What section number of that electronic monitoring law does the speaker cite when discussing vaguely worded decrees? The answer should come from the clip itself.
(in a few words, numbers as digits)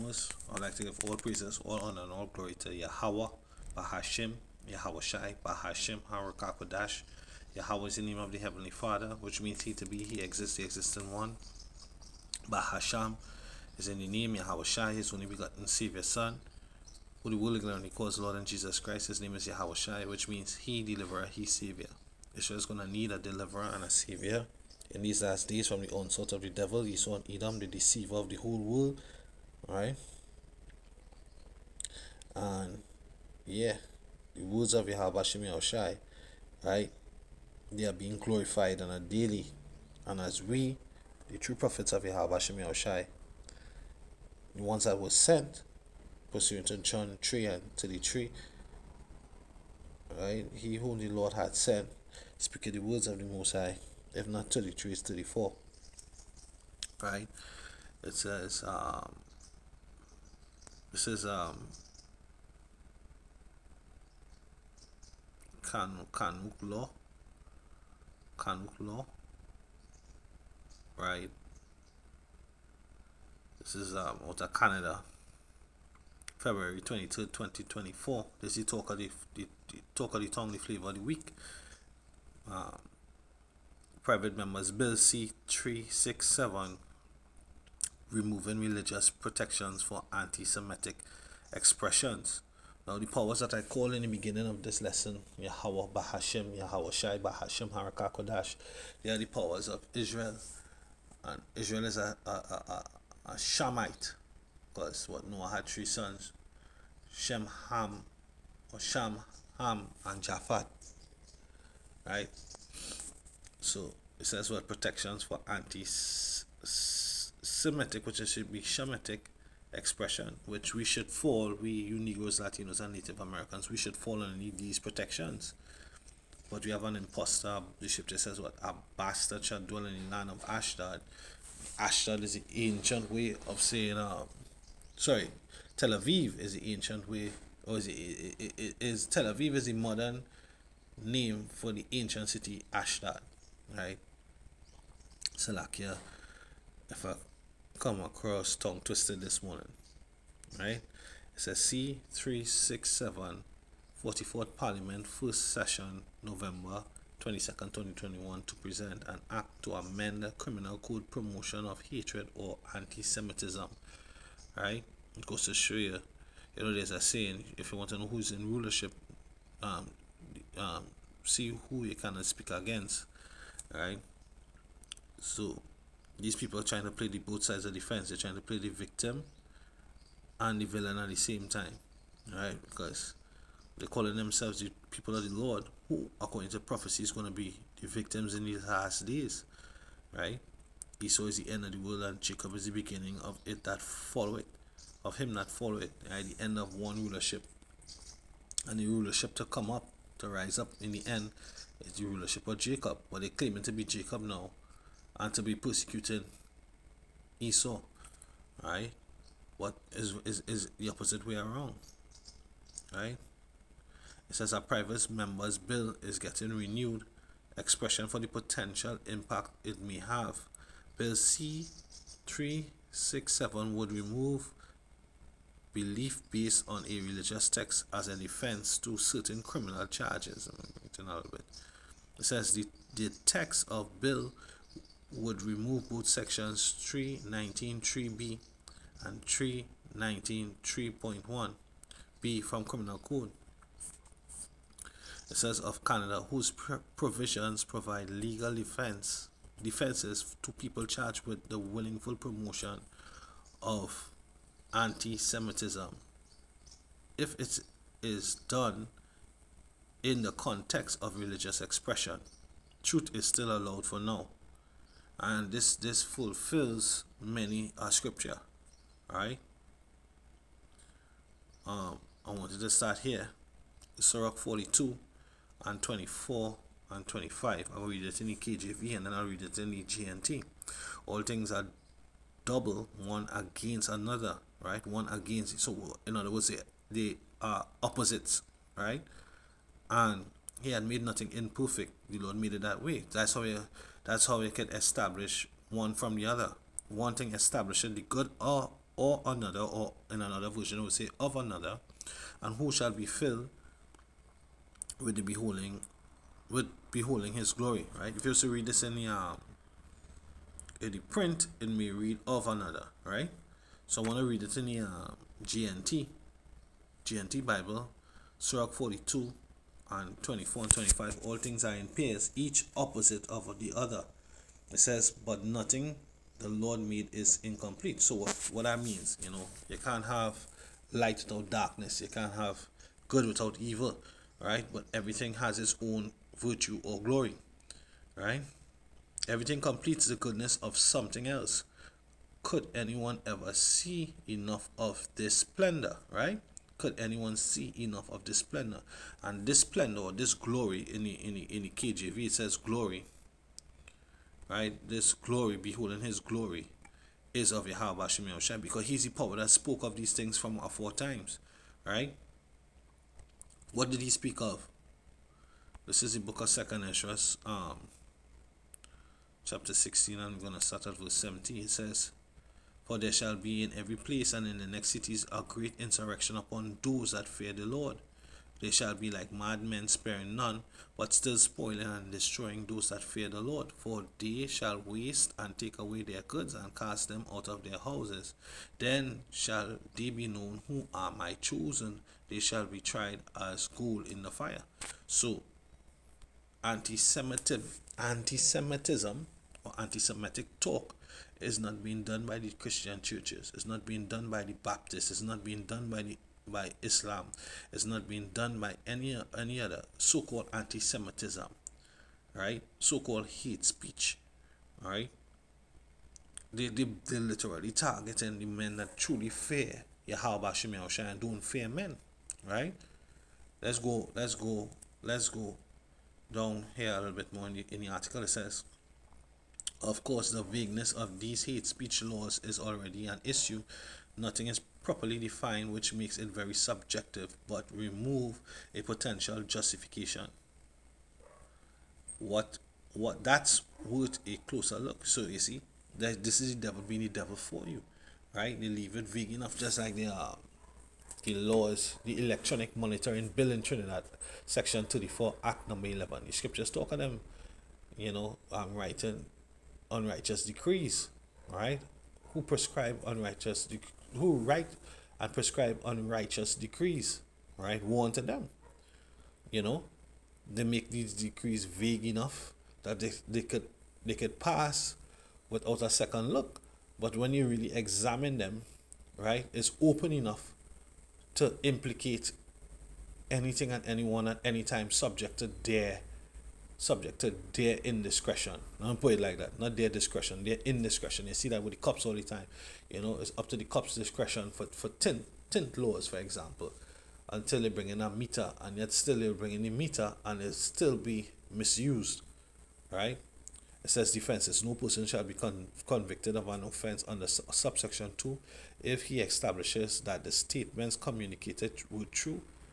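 34.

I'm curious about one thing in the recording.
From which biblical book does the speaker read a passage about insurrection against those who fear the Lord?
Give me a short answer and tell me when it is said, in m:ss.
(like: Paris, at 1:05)
Second Esdras, at 6:06.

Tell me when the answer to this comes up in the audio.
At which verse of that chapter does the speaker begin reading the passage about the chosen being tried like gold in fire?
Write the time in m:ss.
6:11.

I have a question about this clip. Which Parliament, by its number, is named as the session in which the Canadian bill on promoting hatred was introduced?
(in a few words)
44th.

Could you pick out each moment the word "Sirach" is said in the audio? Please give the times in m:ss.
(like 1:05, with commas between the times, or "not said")
4:33, 5:18.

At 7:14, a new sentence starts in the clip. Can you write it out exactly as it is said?
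Nothing is properly defined, which makes it very subjective, but remove a potential justification.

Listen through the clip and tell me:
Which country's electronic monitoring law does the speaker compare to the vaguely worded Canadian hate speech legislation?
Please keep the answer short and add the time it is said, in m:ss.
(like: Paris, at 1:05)
Trinidad, at 7:33.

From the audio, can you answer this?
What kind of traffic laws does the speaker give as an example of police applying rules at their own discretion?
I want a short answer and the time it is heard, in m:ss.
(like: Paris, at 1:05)
Tint laws, at 8:15.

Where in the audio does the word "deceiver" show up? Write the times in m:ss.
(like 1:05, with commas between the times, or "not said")
0:27.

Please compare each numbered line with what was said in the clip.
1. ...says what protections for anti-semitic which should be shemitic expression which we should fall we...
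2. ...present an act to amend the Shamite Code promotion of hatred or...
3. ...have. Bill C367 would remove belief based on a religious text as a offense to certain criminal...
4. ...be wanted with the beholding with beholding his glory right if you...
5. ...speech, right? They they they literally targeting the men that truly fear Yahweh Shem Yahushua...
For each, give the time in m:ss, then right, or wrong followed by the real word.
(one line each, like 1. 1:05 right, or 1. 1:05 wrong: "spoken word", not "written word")
1. 1:54 right
2. 2:38 wrong: "Criminal", not "Shamite"
3. 3:39 wrong: "defense", not "offense"
4. 5:02 wrong: "filled", not "wanted"
5. 6:53 right.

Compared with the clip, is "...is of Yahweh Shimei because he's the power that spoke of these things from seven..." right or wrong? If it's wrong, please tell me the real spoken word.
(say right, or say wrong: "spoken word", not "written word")
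wrong: "four", not "seven".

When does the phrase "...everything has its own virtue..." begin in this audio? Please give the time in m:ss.
5:34.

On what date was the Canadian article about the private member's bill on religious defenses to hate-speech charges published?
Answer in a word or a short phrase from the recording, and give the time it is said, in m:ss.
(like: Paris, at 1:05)
February 22, 2024, at 1:16.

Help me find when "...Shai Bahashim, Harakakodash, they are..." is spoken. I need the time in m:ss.
1:36.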